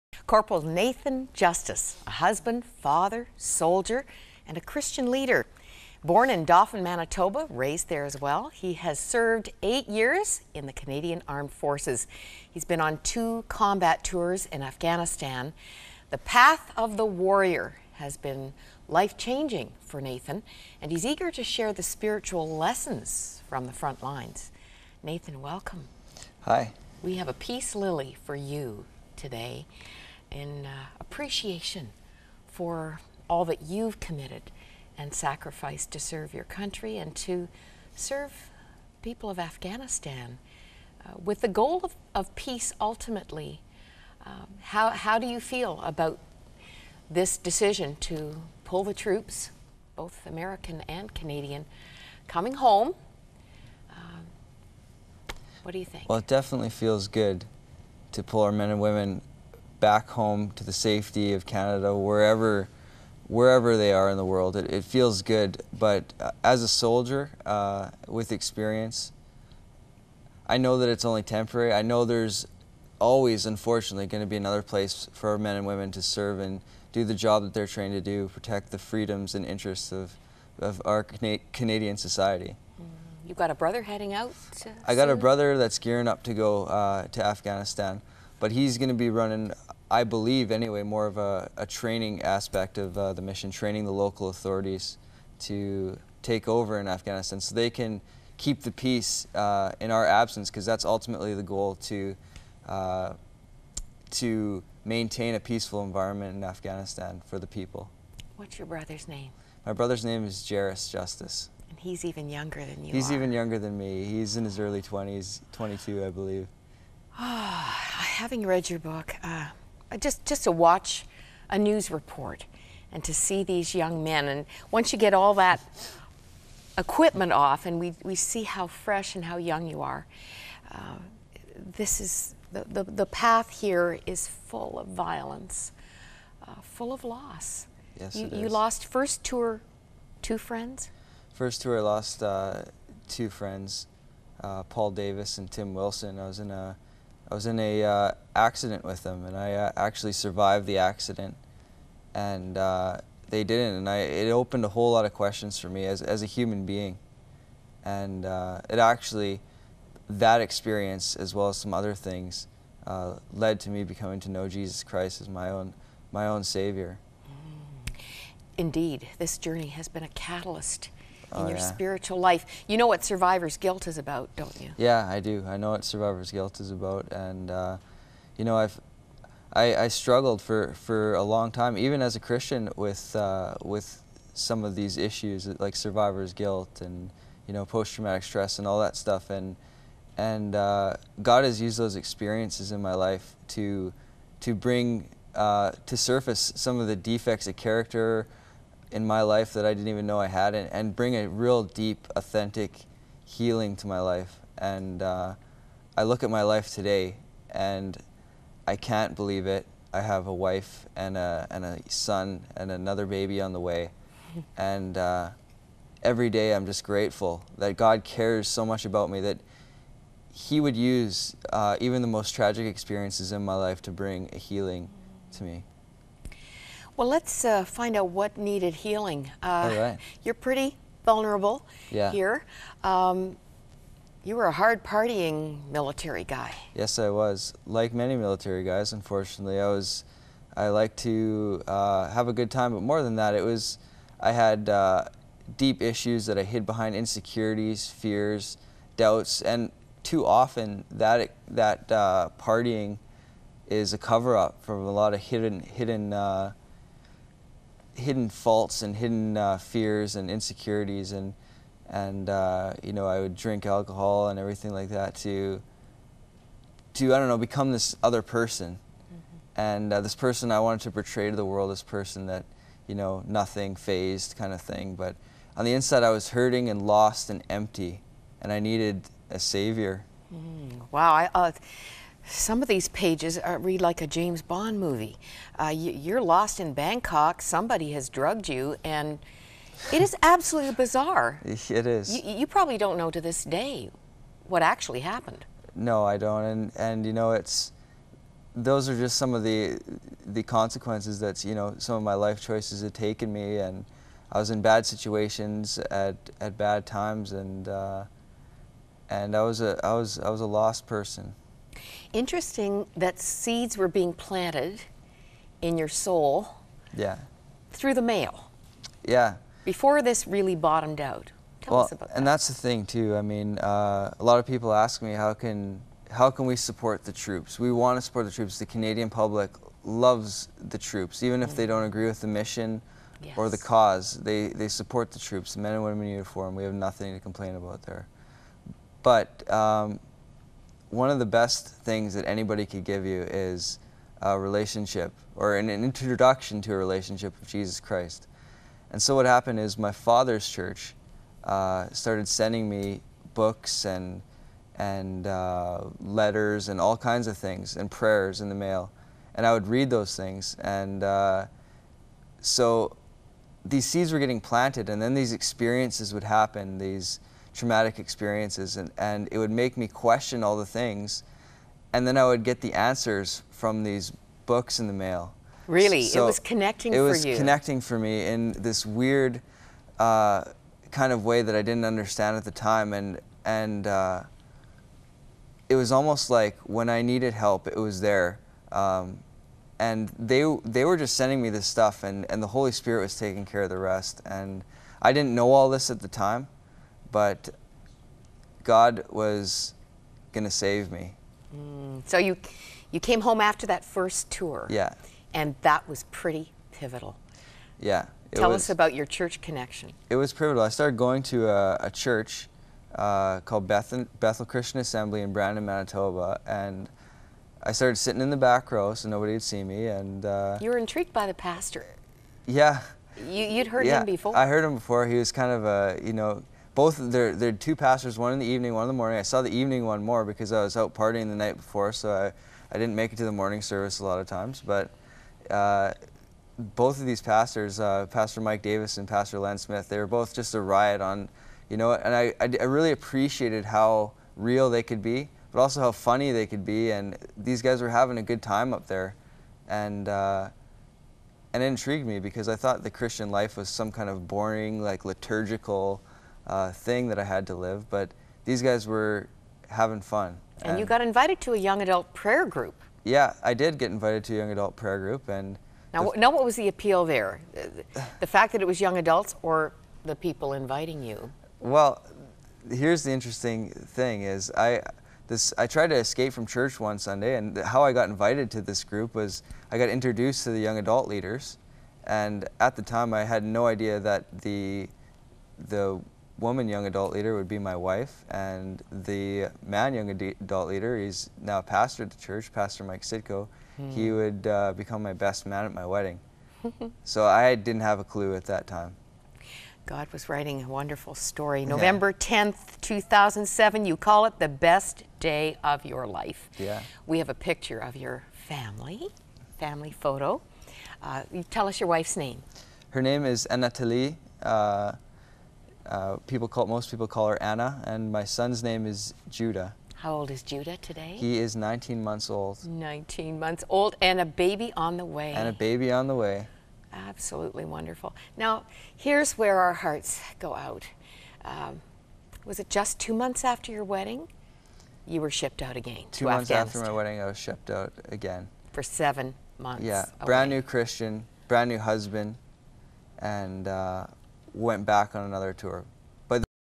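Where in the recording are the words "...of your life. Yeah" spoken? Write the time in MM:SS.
08:25.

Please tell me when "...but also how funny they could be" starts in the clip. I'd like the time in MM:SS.
07:25.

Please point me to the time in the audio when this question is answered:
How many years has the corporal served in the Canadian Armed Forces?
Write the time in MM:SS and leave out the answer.
00:09.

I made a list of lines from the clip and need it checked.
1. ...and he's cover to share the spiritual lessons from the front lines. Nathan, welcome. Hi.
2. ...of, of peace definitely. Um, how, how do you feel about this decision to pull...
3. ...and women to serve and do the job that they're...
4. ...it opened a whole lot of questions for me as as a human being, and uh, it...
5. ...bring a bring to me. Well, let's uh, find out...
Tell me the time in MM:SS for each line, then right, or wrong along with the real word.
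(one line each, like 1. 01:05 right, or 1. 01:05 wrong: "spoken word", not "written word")
1. 00:20 wrong: "eager", not "cover"
2. 00:41 wrong: "ultimately", not "definitely"
3. 01:15 right
4. 02:33 right
5. 03:43 wrong: "healing", not "bring".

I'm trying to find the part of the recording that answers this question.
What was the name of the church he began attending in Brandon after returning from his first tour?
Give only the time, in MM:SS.
06:54.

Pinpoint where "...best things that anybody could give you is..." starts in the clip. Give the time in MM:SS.
05:41.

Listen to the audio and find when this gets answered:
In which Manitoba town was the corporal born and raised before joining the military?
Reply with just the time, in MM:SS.
00:06.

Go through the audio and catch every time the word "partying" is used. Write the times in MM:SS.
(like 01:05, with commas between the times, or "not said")
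03:54, 04:12, 07:10.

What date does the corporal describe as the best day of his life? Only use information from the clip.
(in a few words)
November 10, 2007.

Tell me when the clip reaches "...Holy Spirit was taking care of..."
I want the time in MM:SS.
06:32.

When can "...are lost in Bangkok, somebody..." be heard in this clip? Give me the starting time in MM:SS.
04:46.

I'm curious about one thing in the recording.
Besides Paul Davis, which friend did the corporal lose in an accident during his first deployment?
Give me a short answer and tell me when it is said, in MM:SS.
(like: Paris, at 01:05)
Tim Wilson, at 02:25.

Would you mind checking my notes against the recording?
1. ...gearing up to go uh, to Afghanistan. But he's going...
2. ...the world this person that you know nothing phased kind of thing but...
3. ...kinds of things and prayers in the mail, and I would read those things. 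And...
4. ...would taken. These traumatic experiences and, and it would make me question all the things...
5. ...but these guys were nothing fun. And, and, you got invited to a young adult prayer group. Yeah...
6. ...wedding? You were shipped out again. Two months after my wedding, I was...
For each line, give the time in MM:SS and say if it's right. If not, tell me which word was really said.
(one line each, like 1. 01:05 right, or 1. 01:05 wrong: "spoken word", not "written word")
1. 01:25 right
2. 04:31 right
3. 05:56 right
4. 06:06 wrong: "happen", not "taken"
5. 07:37 wrong: "having", not "nothing"
6. 08:53 right.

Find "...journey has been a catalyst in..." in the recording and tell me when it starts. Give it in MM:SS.
02:49.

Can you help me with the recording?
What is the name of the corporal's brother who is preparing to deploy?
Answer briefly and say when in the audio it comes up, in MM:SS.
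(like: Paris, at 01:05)
Jairus Justice, at 01:50.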